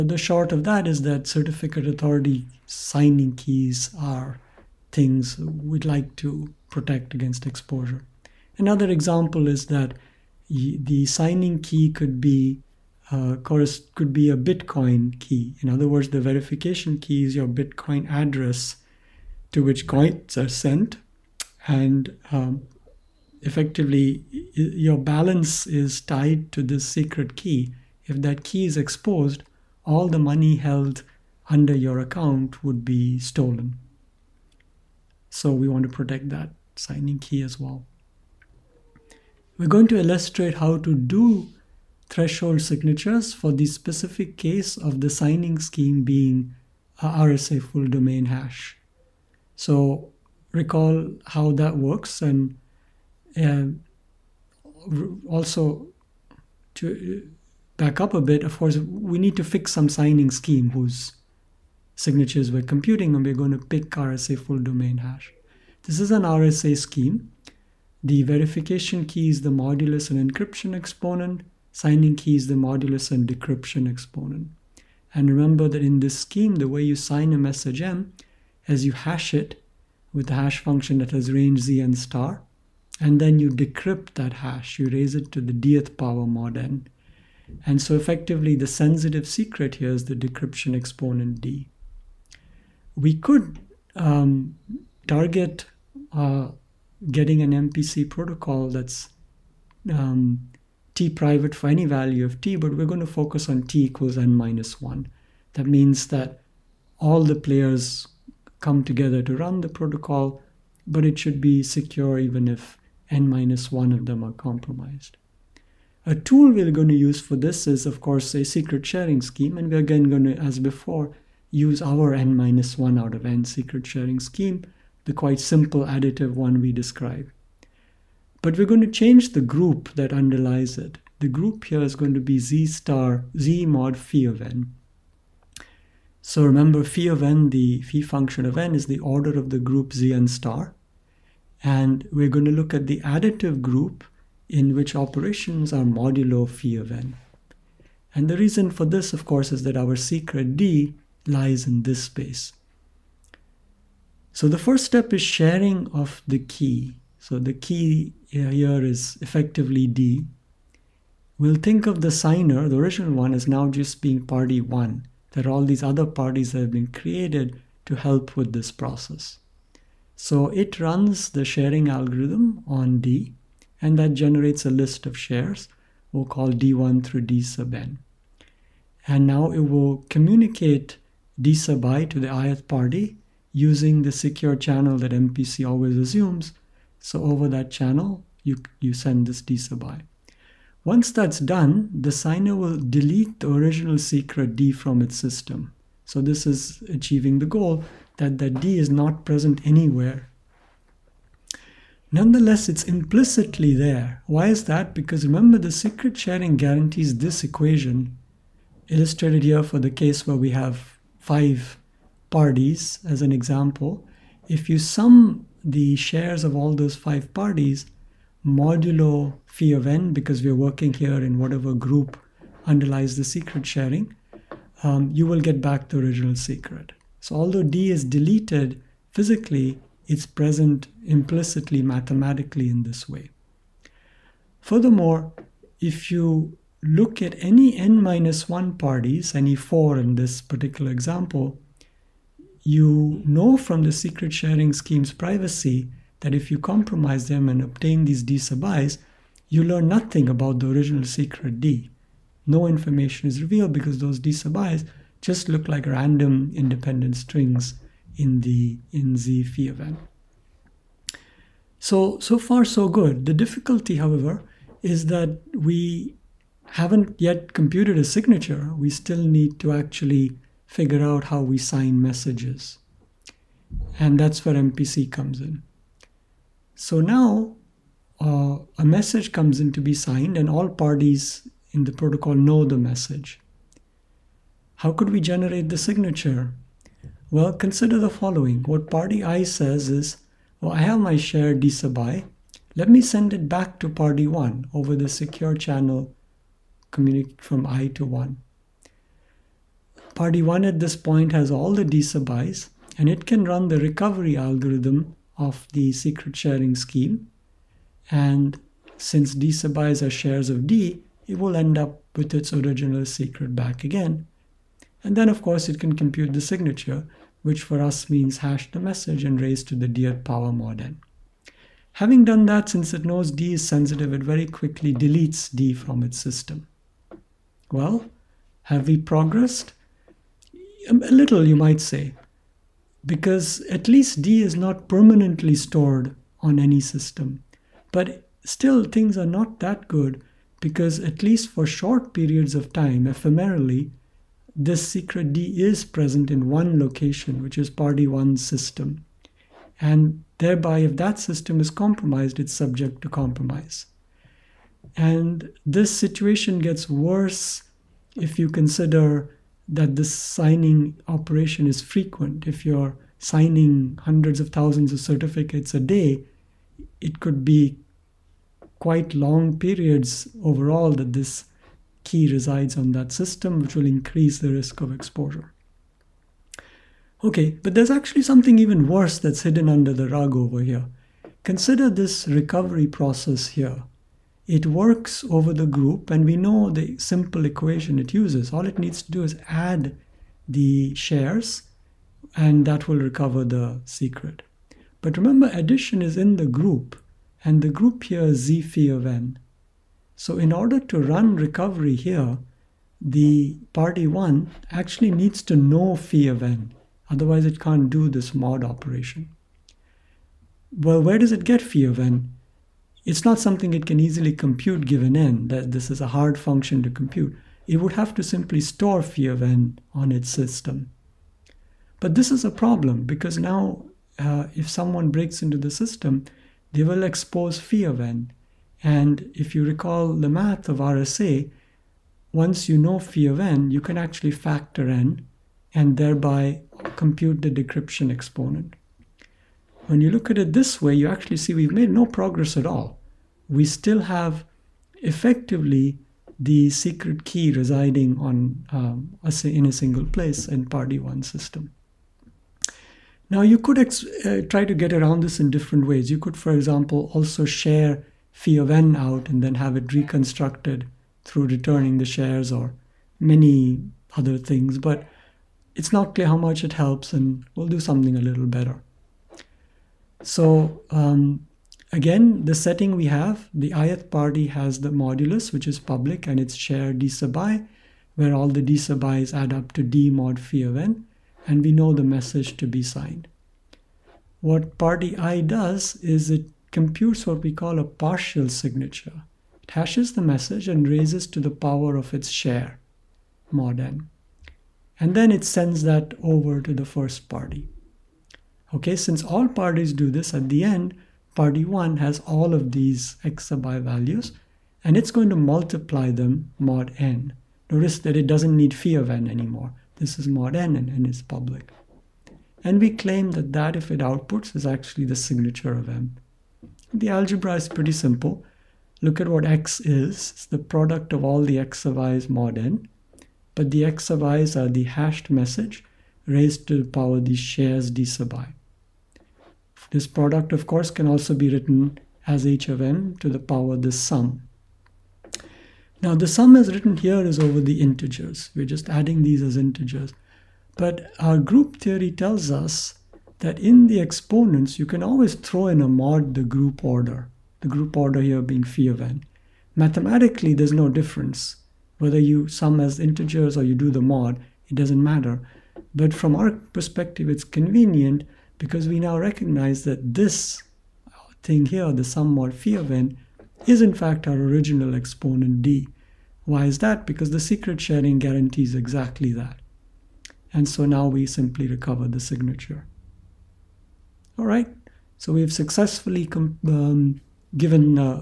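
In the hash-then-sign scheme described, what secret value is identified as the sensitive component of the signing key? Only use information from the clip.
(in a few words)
decryption exponent d.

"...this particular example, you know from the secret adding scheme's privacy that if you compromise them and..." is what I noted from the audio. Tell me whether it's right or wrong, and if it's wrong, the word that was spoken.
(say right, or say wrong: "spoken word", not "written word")
wrong: "sharing", not "adding".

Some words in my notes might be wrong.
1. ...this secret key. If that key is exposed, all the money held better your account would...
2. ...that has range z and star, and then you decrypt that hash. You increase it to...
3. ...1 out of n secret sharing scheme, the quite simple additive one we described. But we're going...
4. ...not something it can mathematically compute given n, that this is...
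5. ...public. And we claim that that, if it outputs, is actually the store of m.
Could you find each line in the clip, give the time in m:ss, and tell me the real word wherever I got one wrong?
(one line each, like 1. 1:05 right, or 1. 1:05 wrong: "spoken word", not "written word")
1. 0:26 wrong: "under", not "better"
2. 1:20 wrong: "raise", not "increase"
3. 2:02 right
4. 6:53 wrong: "easily", not "mathematically"
5. 8:31 wrong: "signature", not "store".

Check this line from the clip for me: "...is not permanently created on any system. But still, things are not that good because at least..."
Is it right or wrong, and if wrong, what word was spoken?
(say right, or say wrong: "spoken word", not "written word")
wrong: "stored", not "created".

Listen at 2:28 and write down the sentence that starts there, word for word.
And the reason for this, of course, is that our secret D lies in this space.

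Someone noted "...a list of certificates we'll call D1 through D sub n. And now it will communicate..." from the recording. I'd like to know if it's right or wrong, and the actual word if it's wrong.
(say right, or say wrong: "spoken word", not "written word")
wrong: "shares", not "certificates".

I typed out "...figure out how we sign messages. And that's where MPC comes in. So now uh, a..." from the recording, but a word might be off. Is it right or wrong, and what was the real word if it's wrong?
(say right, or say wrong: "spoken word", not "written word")
right.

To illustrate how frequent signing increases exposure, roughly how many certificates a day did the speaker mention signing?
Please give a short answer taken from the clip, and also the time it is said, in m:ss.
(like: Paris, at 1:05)
hundreds of thousands, at 6:04.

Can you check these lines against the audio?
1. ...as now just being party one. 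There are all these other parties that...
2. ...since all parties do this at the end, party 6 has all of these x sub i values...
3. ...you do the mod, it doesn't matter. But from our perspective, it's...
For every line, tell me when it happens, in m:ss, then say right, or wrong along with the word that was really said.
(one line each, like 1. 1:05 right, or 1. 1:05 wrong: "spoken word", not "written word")
1. 2:43 right
2. 8:18 wrong: "1", not "6"
3. 9:13 right.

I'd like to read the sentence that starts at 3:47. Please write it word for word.
So although D is deleted physically, it's present implicitly mathematically in this way.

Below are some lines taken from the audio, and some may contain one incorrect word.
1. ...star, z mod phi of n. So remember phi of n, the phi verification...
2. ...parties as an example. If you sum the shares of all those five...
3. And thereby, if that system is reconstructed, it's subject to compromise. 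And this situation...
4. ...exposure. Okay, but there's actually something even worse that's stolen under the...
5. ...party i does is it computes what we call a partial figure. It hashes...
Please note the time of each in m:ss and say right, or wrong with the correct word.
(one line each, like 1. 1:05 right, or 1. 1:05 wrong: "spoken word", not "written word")
1. 2:12 wrong: "function", not "verification"
2. 3:32 right
3. 5:49 wrong: "compromised", not "reconstructed"
4. 6:14 wrong: "hidden", not "stolen"
5. 8:04 wrong: "signature", not "figure".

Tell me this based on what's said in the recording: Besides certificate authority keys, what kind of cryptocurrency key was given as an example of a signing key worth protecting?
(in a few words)
Bitcoin key.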